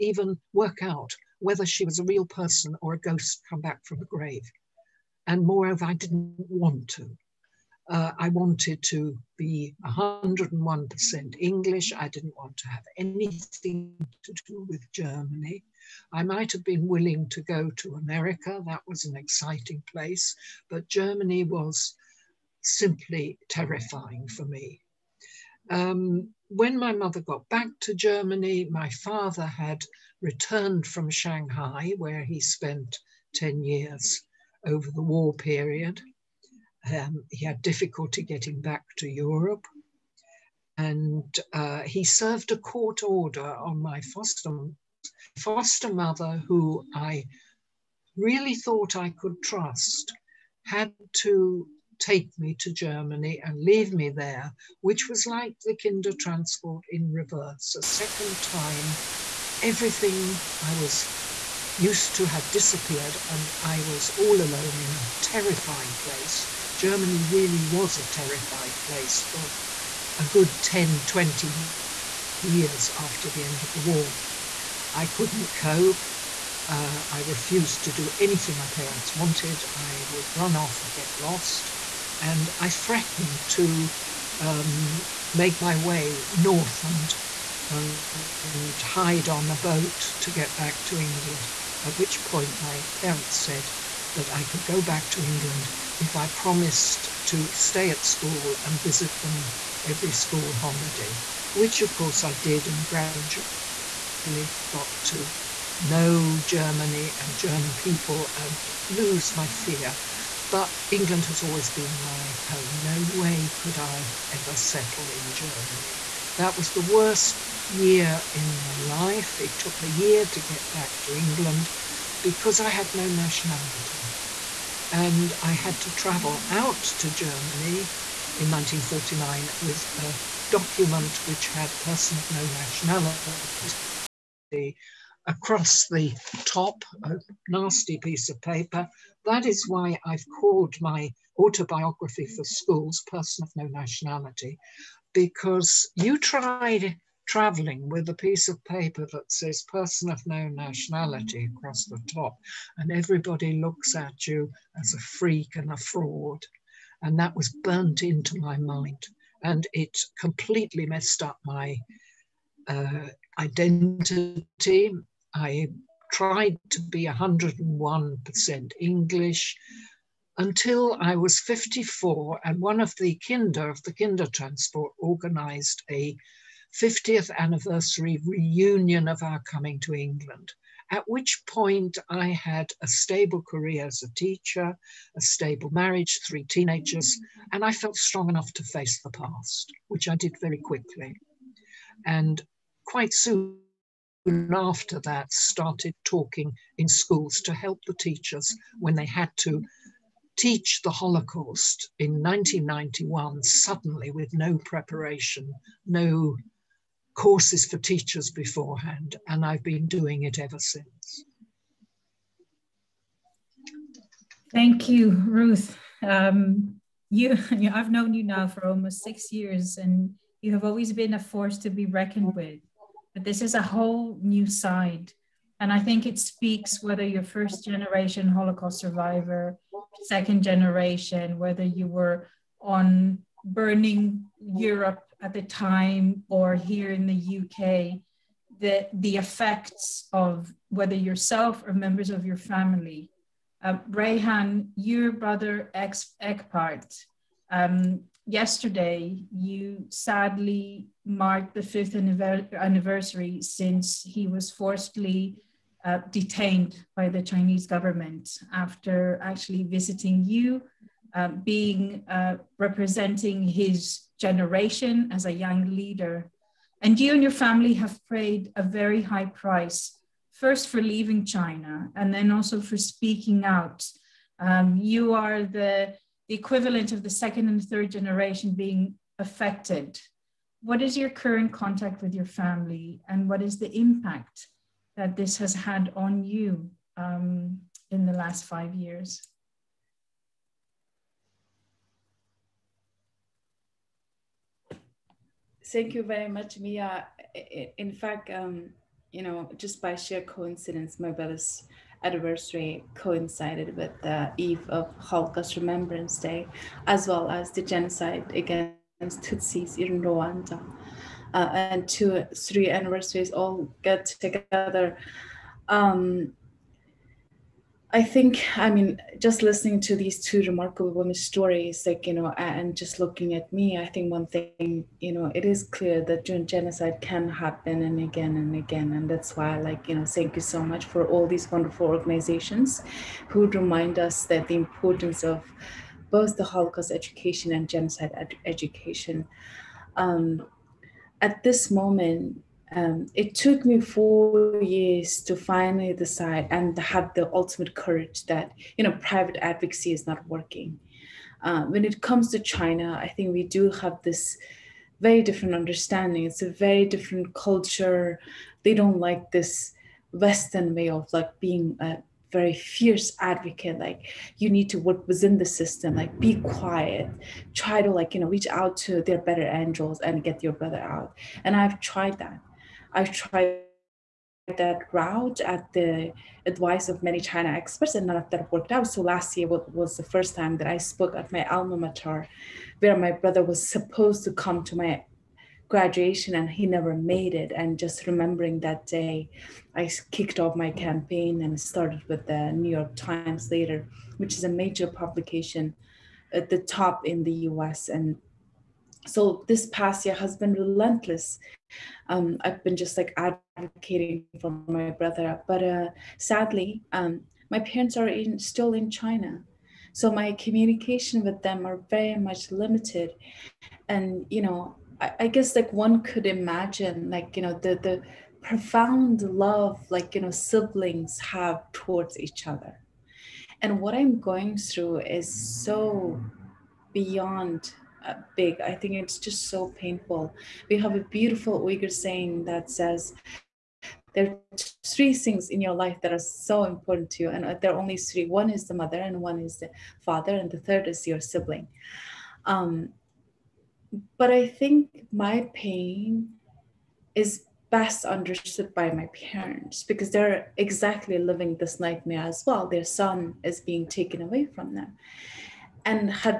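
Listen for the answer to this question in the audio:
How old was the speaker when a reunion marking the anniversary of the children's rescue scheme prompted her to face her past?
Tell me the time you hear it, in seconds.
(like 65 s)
171 s.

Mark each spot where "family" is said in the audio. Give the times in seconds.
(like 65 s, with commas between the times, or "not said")
242 s, 267 s, 282 s.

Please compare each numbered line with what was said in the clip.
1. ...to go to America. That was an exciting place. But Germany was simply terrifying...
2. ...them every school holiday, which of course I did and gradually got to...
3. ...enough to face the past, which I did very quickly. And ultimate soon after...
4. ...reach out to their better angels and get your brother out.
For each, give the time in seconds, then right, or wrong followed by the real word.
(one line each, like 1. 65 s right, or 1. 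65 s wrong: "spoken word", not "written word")
1. 17 s right
2. 99 s right
3. 188 s wrong: "quite", not "ultimate"
4. 368 s right.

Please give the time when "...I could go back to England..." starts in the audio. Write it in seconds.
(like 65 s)
94 s.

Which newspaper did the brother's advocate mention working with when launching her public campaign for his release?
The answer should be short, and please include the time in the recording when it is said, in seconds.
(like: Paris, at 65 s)
New York Times, at 392 s.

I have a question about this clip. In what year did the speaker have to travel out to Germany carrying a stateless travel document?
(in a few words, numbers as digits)
1949.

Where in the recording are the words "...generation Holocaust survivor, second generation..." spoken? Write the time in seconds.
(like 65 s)
227 s.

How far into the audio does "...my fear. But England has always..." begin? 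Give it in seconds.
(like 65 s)
109 s.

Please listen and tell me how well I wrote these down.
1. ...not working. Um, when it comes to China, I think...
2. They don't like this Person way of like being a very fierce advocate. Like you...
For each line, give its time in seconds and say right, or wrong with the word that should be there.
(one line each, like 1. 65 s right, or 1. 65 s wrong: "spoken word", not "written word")
1. 350 s right
2. 358 s wrong: "Western", not "Person".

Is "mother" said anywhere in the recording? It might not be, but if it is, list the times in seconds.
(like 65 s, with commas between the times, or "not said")
26 s, 45 s, 438 s.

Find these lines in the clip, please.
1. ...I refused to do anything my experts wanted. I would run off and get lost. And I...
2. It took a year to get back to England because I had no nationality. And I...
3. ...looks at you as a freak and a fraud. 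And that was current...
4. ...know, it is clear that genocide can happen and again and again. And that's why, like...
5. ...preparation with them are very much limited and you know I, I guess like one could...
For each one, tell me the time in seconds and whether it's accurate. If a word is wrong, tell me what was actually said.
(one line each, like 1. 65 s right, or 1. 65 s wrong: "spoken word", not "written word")
1. 77 s wrong: "parents", not "experts"
2. 119 s right
3. 153 s wrong: "burnt", not "current"
4. 325 s right
5. 410 s wrong: "communication", not "preparation".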